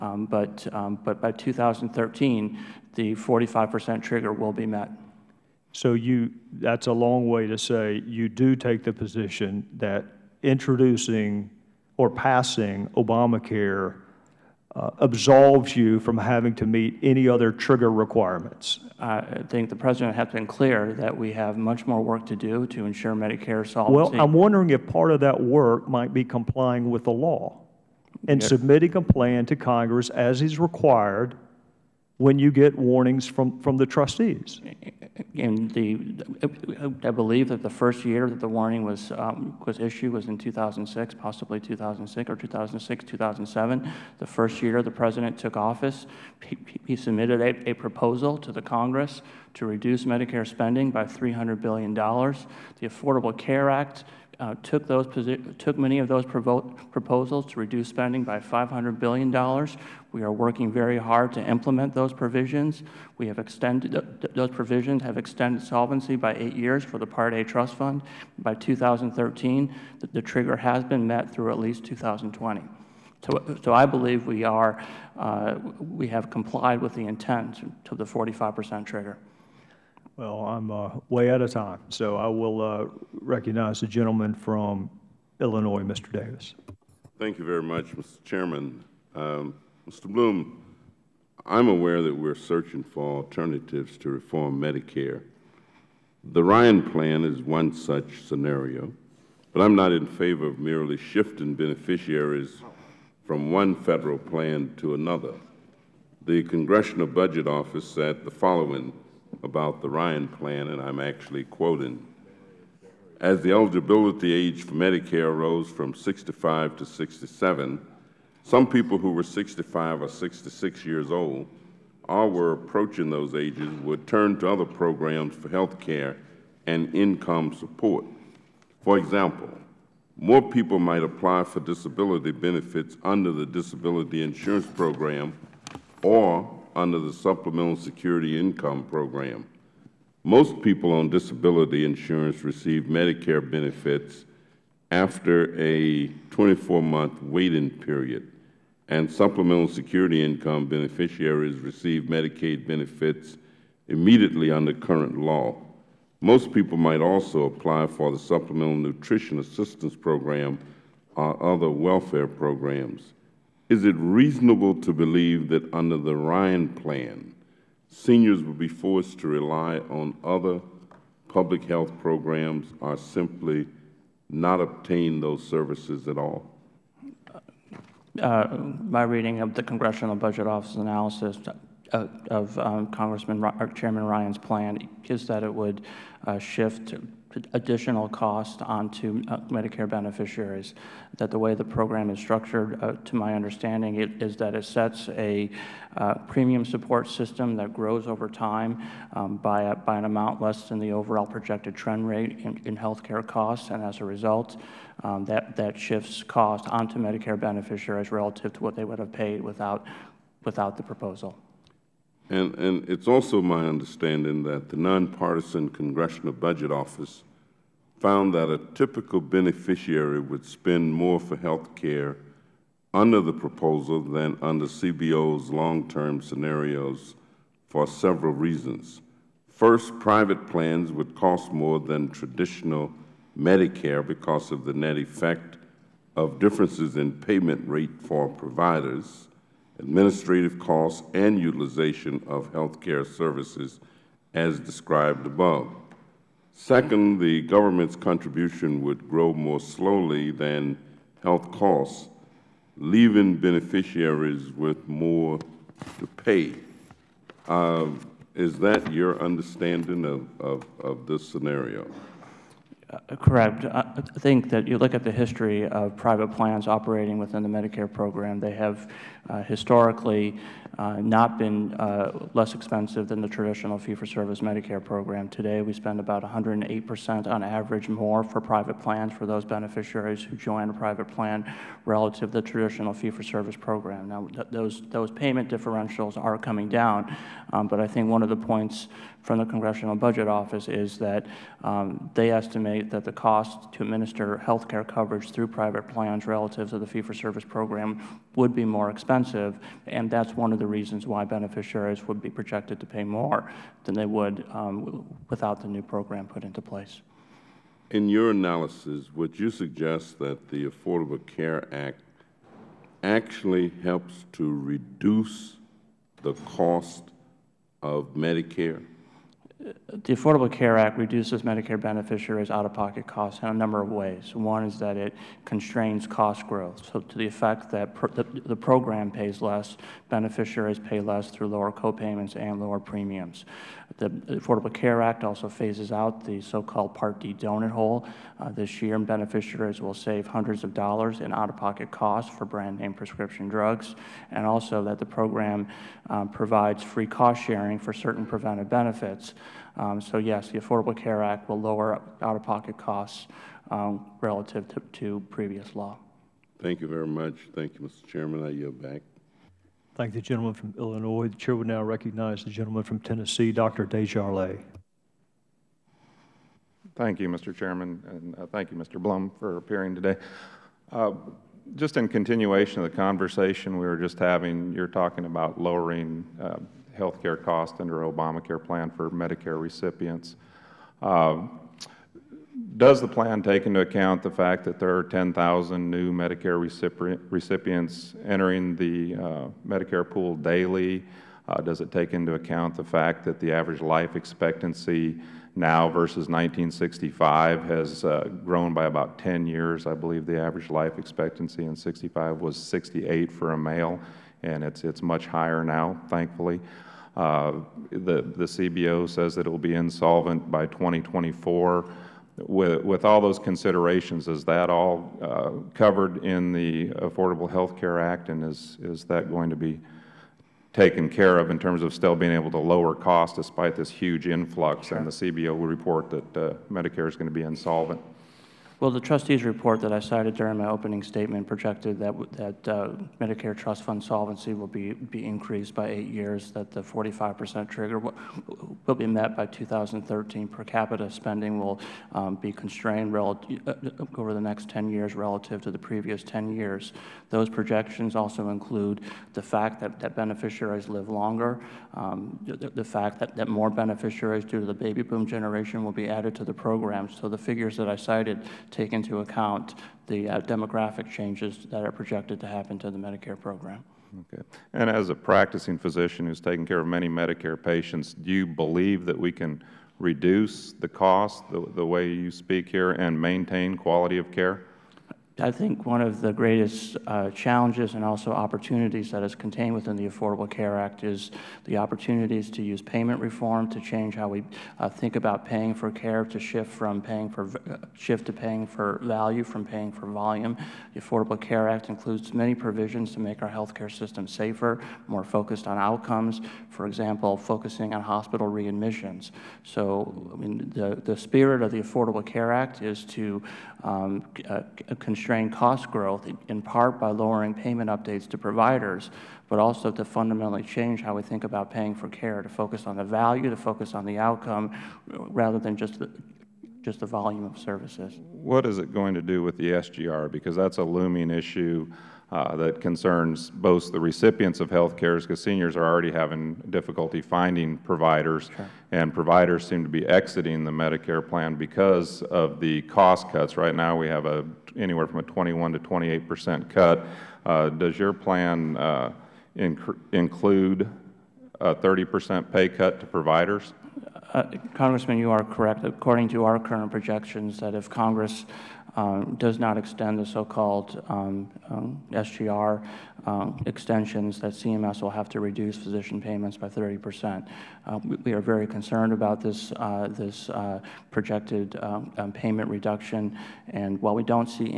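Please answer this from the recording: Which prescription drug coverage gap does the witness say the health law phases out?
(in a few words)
Part D donut hole.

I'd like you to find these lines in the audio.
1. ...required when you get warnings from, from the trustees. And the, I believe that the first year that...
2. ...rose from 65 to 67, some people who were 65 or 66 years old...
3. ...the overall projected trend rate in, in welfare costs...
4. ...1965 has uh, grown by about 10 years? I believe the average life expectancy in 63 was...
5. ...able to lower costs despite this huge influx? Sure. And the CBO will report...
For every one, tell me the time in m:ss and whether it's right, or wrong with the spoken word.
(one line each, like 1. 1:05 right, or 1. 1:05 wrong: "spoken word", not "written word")
1. 0:30 right
2. 1:55 right
3. 3:20 wrong: "healthcare", not "welfare"
4. 6:36 wrong: "65", not "63"
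5. 7:02 right.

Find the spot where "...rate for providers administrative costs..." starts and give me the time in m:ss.
3:57.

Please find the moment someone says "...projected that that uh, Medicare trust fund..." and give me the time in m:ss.
7:11.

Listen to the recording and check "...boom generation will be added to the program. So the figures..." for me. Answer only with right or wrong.
right.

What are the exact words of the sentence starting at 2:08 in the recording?
For example, more people might apply for disability benefits under the Disability Insurance Program or under the Supplemental Security Income Program.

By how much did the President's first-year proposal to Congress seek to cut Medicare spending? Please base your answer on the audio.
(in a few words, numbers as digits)
$300 billion.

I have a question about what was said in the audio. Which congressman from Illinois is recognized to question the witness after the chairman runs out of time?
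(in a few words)
Mr. Davis.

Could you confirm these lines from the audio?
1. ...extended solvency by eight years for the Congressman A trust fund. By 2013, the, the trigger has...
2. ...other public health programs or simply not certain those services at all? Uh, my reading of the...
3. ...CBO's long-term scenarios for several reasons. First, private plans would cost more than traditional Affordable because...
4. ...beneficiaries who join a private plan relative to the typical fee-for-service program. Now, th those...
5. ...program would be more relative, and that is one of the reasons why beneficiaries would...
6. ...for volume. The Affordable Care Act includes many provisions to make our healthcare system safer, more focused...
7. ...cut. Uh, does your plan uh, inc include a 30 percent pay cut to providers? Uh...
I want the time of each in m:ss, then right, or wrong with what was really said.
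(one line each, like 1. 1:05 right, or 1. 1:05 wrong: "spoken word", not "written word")
1. 1:05 wrong: "Part", not "Congressman"
2. 2:50 wrong: "obtain", not "certain"
3. 3:44 wrong: "Medicare", not "Affordable"
4. 4:39 wrong: "traditional", not "typical"
5. 4:57 wrong: "expensive", not "relative"
6. 8:09 right
7. 8:56 right.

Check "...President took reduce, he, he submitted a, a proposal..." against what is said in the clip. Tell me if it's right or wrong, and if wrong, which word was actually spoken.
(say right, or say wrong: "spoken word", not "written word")
wrong: "office", not "reduce".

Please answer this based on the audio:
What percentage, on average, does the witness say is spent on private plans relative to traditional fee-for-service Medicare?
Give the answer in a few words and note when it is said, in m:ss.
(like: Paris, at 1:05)
108 percent, at 4:36.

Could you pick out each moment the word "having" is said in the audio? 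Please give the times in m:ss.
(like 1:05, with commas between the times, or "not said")
0:16, 6:14, 8:46.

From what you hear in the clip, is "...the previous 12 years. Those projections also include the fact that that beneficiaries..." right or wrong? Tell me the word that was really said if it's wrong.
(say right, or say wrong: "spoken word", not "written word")
wrong: "10", not "12".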